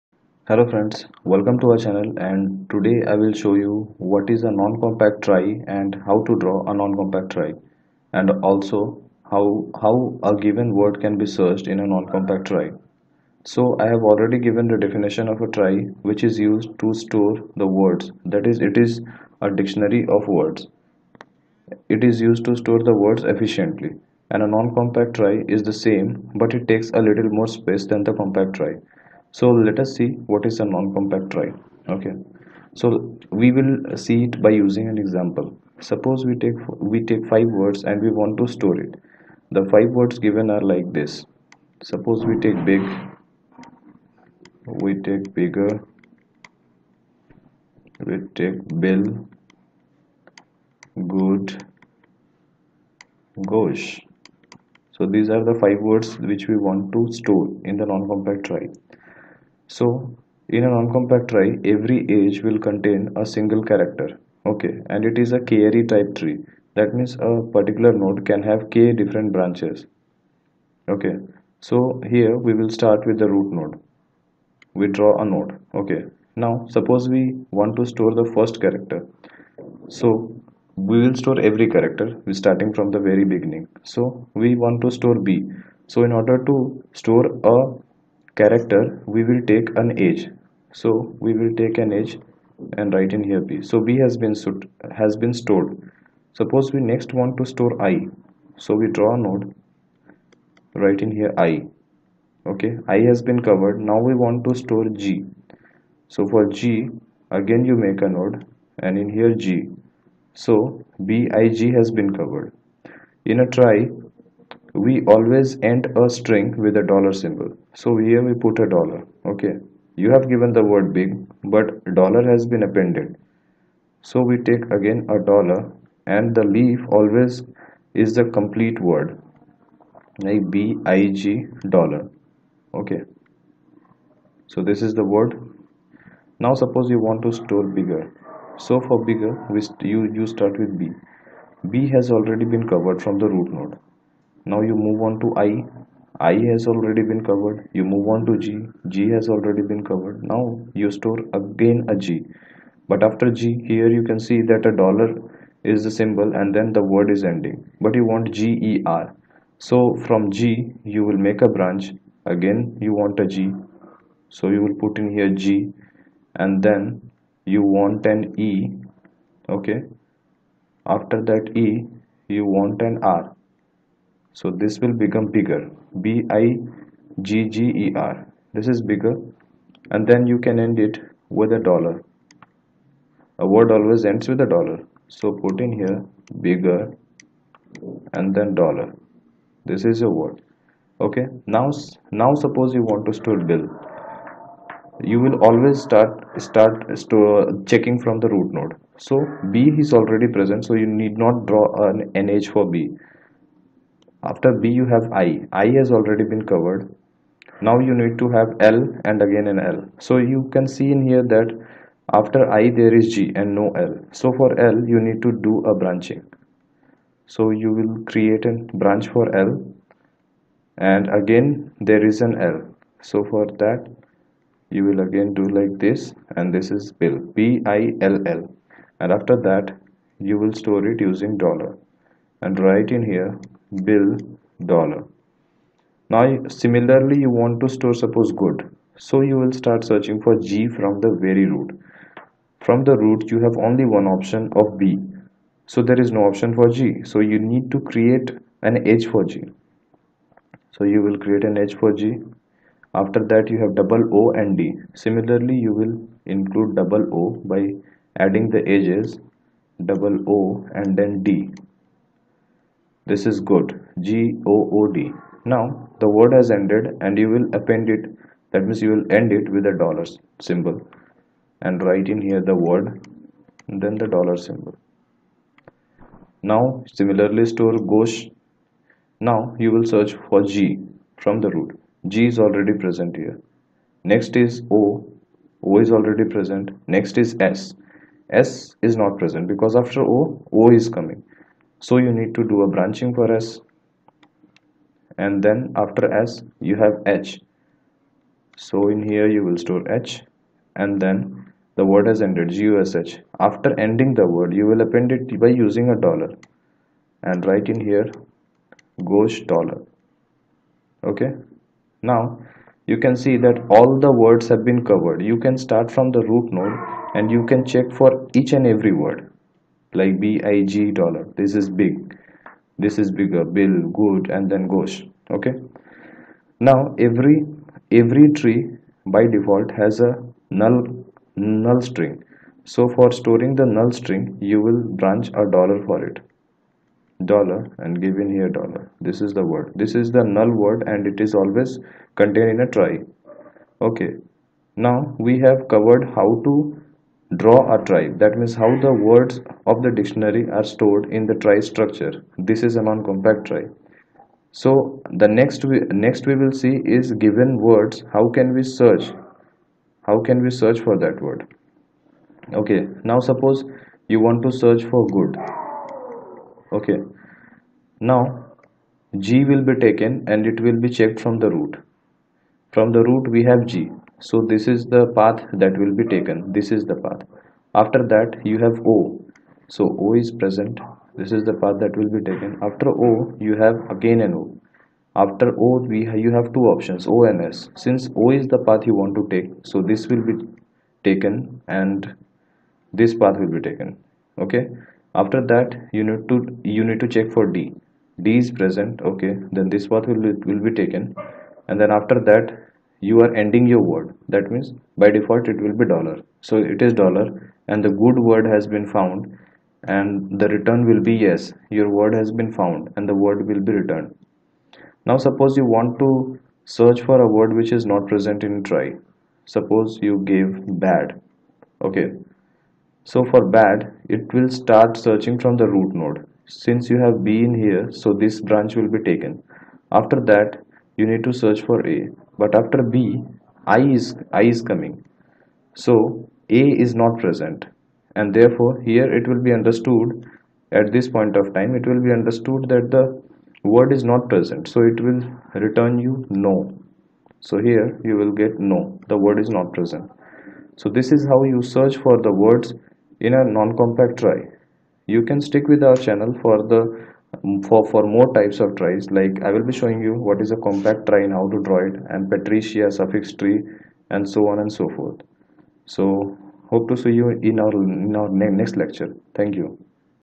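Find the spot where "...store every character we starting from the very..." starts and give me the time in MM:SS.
01:21.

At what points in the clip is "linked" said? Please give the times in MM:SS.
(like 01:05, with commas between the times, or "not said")
not said.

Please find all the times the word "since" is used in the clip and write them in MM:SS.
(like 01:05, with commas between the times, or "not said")
06:27, 07:06.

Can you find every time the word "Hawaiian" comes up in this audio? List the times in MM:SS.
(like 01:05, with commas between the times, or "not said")
not said.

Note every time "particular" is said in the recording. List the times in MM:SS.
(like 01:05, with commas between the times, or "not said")
01:07.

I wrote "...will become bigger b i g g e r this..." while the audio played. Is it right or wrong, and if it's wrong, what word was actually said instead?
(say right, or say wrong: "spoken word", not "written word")
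right.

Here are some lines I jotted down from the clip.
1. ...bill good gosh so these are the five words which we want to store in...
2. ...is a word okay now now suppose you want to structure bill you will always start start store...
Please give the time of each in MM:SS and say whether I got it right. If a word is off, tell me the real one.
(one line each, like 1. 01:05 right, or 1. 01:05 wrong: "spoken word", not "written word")
1. 00:48 right
2. 03:09 wrong: "store", not "structure".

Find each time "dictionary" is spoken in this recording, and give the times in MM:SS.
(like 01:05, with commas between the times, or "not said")
00:19, 05:49.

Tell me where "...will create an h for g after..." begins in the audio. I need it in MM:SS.
04:11.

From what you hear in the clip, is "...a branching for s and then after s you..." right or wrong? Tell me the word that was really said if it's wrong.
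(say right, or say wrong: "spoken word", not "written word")
right.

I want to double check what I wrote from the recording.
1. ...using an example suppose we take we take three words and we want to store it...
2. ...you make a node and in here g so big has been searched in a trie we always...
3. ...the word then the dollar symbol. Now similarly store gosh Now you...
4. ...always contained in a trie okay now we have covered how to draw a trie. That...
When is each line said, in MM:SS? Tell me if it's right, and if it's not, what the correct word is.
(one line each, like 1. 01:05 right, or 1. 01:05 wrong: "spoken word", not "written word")
1. 00:34 wrong: "five", not "three"
2. 01:47 wrong: "covered", not "searched"
3. 04:32 right
4. 05:41 right.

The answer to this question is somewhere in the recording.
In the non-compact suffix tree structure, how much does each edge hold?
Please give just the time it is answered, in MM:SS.
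01:03.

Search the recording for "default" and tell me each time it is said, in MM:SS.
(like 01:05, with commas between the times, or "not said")
05:29, 06:45.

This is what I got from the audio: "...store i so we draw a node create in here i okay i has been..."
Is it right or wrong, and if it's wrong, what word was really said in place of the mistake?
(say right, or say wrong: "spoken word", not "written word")
wrong: "write", not "create".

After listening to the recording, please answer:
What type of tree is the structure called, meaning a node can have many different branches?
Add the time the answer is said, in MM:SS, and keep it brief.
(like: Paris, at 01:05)
K-ary, at 01:05.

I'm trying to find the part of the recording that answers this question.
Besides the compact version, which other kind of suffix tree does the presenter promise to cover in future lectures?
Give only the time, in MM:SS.
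07:42.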